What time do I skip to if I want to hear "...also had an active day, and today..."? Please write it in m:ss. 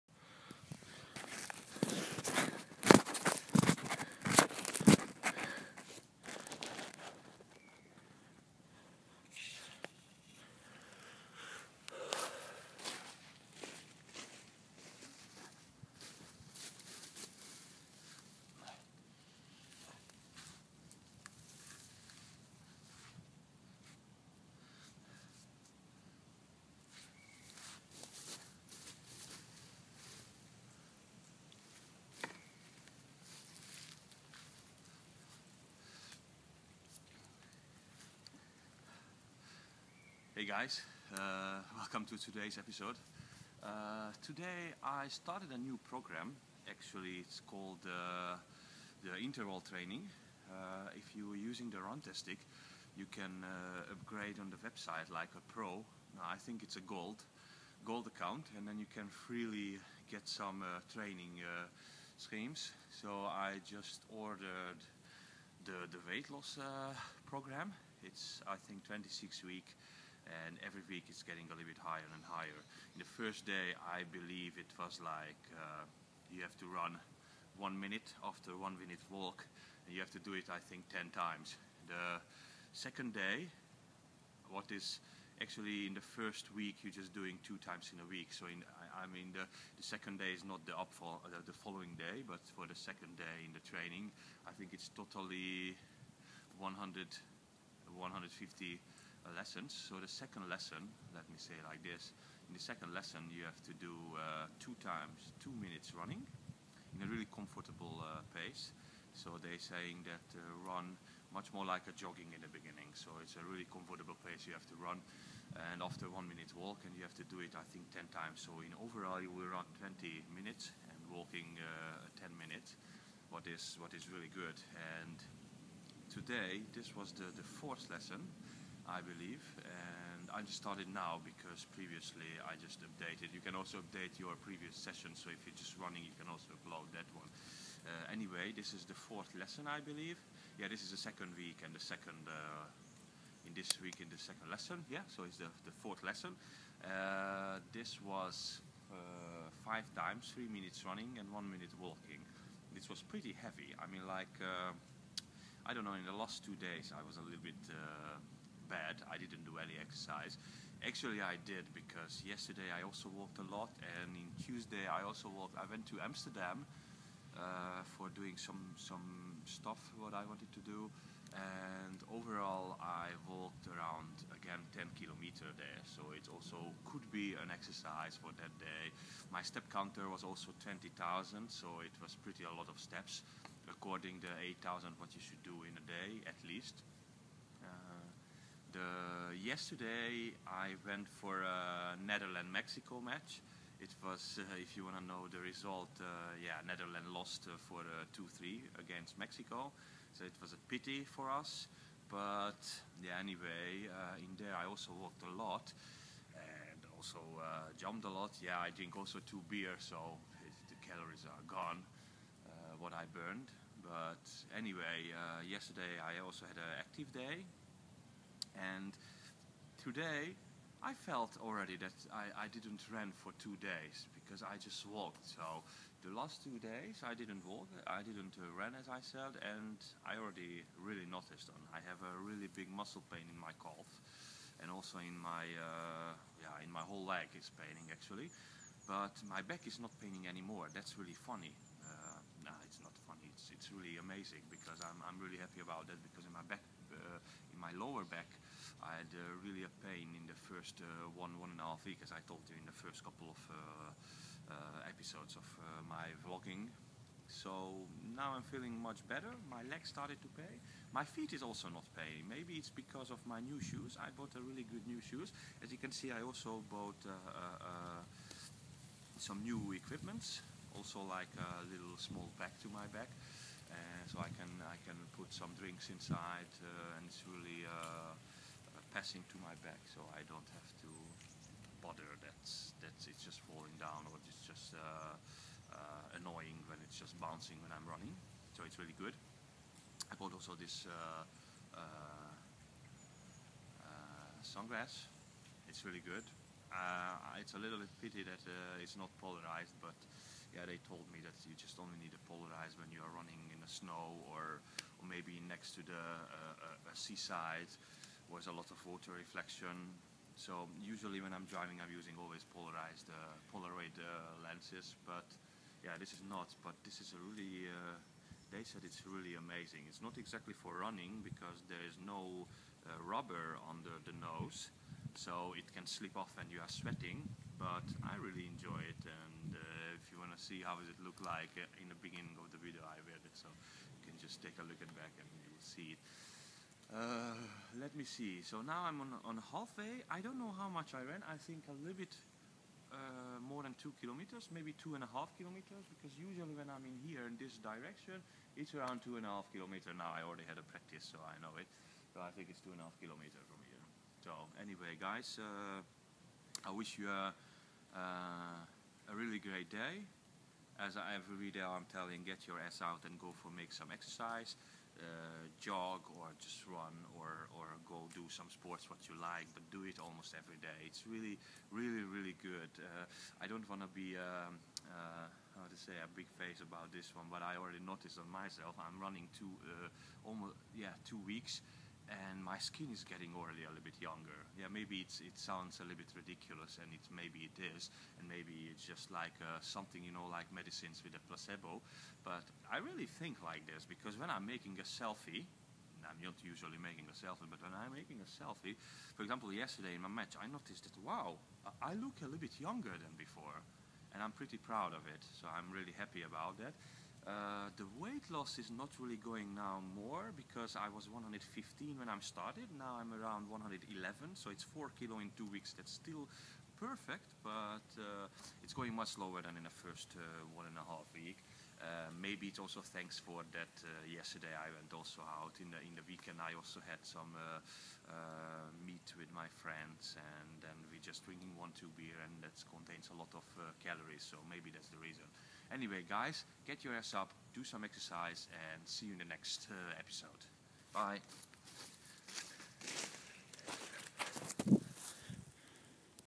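3:36.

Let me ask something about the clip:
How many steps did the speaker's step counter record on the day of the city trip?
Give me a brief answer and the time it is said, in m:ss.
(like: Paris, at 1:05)
20,000, at 3:00.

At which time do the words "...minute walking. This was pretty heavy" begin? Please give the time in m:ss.
2:31.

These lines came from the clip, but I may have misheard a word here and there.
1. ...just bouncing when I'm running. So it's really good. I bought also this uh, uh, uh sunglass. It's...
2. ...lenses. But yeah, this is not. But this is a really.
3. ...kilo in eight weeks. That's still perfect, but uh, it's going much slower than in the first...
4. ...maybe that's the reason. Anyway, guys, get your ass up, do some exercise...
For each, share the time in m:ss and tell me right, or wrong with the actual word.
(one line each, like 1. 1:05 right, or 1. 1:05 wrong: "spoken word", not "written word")
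1. 4:46 right
2. 5:14 right
3. 6:54 wrong: "two", not "eight"
4. 7:14 right.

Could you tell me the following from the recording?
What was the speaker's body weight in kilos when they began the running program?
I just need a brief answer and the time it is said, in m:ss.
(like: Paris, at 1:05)
115, at 6:51.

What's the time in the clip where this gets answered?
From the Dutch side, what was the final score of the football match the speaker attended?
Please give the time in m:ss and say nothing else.
3:18.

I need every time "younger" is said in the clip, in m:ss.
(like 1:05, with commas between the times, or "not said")
6:24, 6:42.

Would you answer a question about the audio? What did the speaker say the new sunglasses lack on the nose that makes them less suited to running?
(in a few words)
rubber.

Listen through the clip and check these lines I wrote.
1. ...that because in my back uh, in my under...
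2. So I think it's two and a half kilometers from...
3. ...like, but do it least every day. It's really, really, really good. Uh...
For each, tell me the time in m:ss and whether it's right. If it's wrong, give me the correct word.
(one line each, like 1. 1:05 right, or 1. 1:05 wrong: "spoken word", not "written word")
1. 4:05 wrong: "lower", not "under"
2. 5:52 right
3. 6:09 wrong: "almost", not "least".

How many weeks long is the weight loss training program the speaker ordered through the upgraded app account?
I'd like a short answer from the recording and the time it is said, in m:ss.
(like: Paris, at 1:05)
26, at 1:08.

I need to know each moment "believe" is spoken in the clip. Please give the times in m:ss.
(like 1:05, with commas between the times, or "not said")
1:14, 2:08, 2:19.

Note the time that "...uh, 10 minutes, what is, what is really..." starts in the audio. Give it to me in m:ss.
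2:01.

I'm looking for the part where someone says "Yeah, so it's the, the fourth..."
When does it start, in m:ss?
2:24.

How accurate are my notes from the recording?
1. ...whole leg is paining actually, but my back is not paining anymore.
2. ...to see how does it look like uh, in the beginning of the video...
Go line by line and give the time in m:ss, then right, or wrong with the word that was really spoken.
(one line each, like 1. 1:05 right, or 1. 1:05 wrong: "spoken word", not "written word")
1. 3:56 right
2. 5:30 right.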